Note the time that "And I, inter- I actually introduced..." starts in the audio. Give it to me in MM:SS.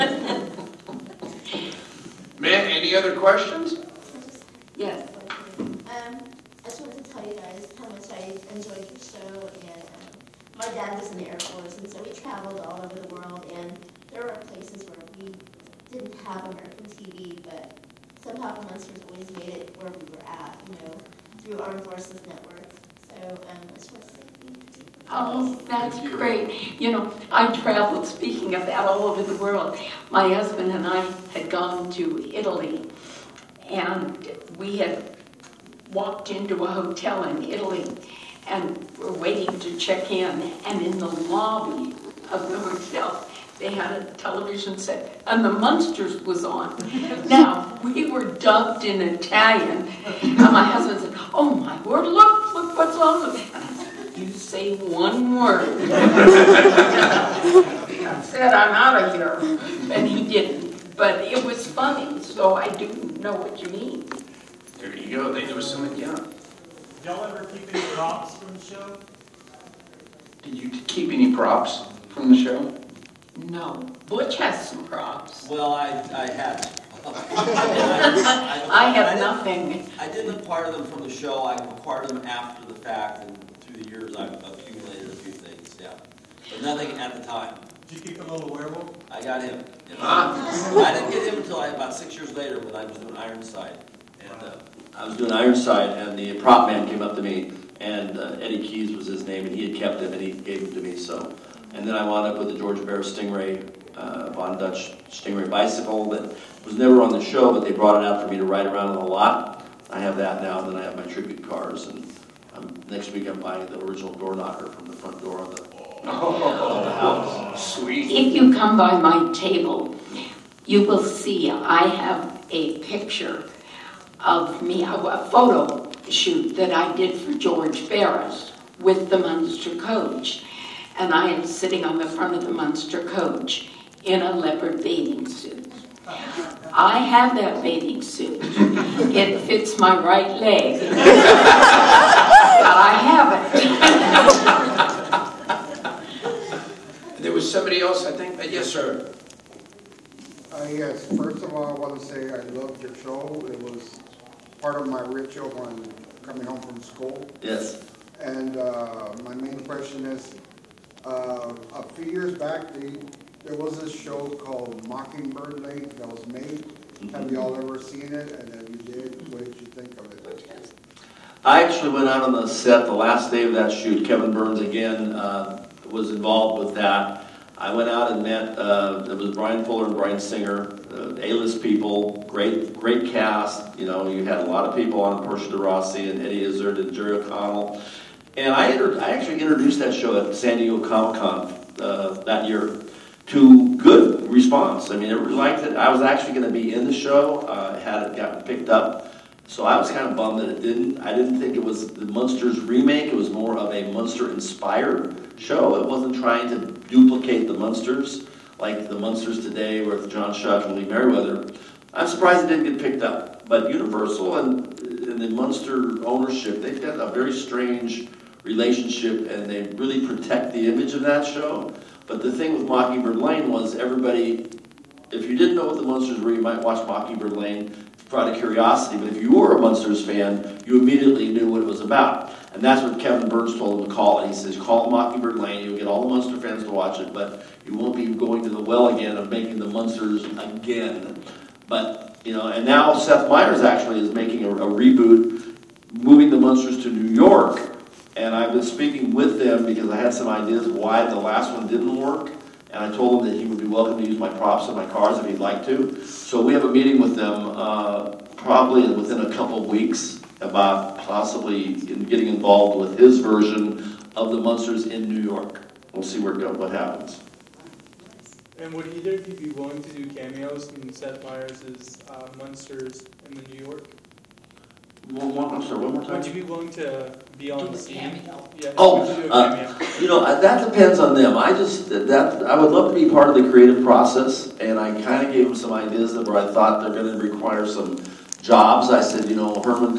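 03:08.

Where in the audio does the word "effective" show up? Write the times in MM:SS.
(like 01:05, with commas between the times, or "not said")
not said.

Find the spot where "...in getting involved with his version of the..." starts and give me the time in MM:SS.
04:21.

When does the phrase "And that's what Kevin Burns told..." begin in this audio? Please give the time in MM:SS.
03:52.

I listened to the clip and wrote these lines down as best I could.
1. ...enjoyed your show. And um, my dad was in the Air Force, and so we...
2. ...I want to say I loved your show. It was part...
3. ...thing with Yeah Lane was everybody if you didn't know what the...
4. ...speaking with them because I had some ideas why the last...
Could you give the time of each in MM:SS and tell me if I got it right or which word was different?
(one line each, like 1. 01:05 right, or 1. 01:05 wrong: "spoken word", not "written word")
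1. 00:08 right
2. 02:31 right
3. 03:42 wrong: "Mockingbird", not "Yeah"
4. 04:08 right.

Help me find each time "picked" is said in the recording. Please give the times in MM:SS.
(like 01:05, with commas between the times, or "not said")
03:18, 03:32.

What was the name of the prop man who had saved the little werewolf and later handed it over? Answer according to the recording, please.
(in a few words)
Eddie Keys.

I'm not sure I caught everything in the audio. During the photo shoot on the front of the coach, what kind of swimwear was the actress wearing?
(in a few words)
leopard bathing suit.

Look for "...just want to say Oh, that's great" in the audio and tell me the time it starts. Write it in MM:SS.
00:23.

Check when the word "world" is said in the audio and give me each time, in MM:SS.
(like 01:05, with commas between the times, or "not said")
00:13, 00:29.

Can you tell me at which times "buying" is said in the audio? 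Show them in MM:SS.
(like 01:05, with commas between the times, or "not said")
01:53.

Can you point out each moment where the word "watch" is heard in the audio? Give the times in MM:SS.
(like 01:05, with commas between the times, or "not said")
03:46, 03:56.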